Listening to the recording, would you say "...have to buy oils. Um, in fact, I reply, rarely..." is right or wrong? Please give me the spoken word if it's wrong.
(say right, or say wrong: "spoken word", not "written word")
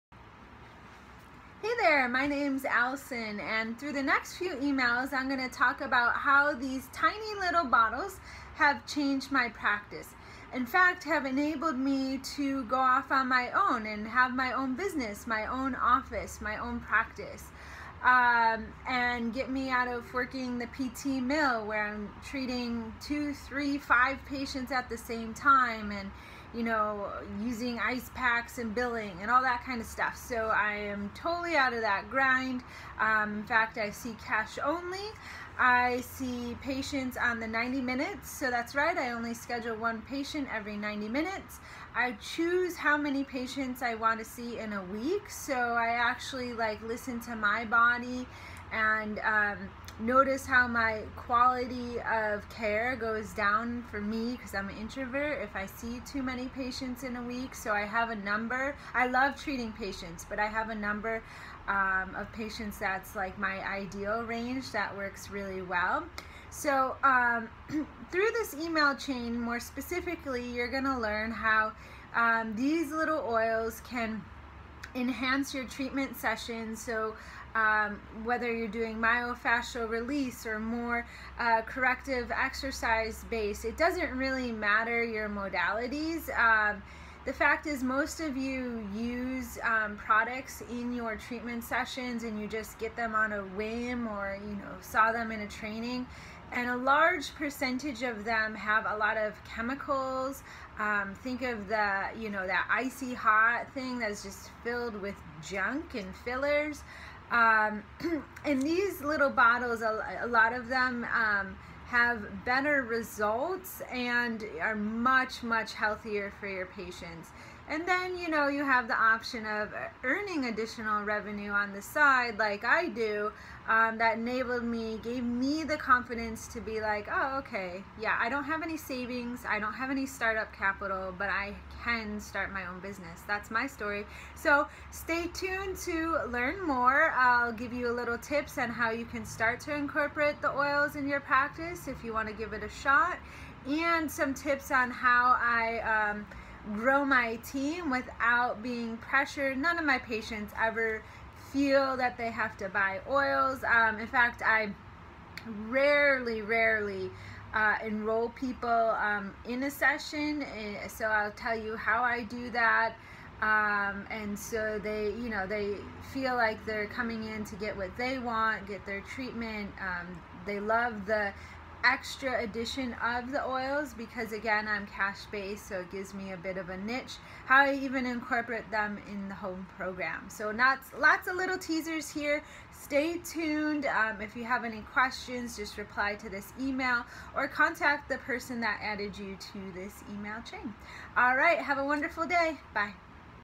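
wrong: "rarely", not "reply".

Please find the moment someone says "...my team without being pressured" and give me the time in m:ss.
2:27.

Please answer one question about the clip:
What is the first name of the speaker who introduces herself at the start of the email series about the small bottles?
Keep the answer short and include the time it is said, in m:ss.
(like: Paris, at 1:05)
Alison, at 0:02.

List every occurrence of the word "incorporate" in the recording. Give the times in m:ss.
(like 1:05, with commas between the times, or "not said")
2:19, 2:58.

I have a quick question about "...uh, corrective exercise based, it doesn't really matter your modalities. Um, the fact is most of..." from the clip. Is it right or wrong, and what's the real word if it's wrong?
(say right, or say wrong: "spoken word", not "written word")
right.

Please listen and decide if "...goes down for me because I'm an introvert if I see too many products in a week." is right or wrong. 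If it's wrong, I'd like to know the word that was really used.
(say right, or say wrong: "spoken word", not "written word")
wrong: "patients", not "products".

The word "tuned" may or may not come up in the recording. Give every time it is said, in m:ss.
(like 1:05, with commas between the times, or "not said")
2:15, 3:03.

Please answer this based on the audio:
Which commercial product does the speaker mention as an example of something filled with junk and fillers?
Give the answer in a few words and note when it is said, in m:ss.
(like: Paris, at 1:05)
Icy Hot, at 1:42.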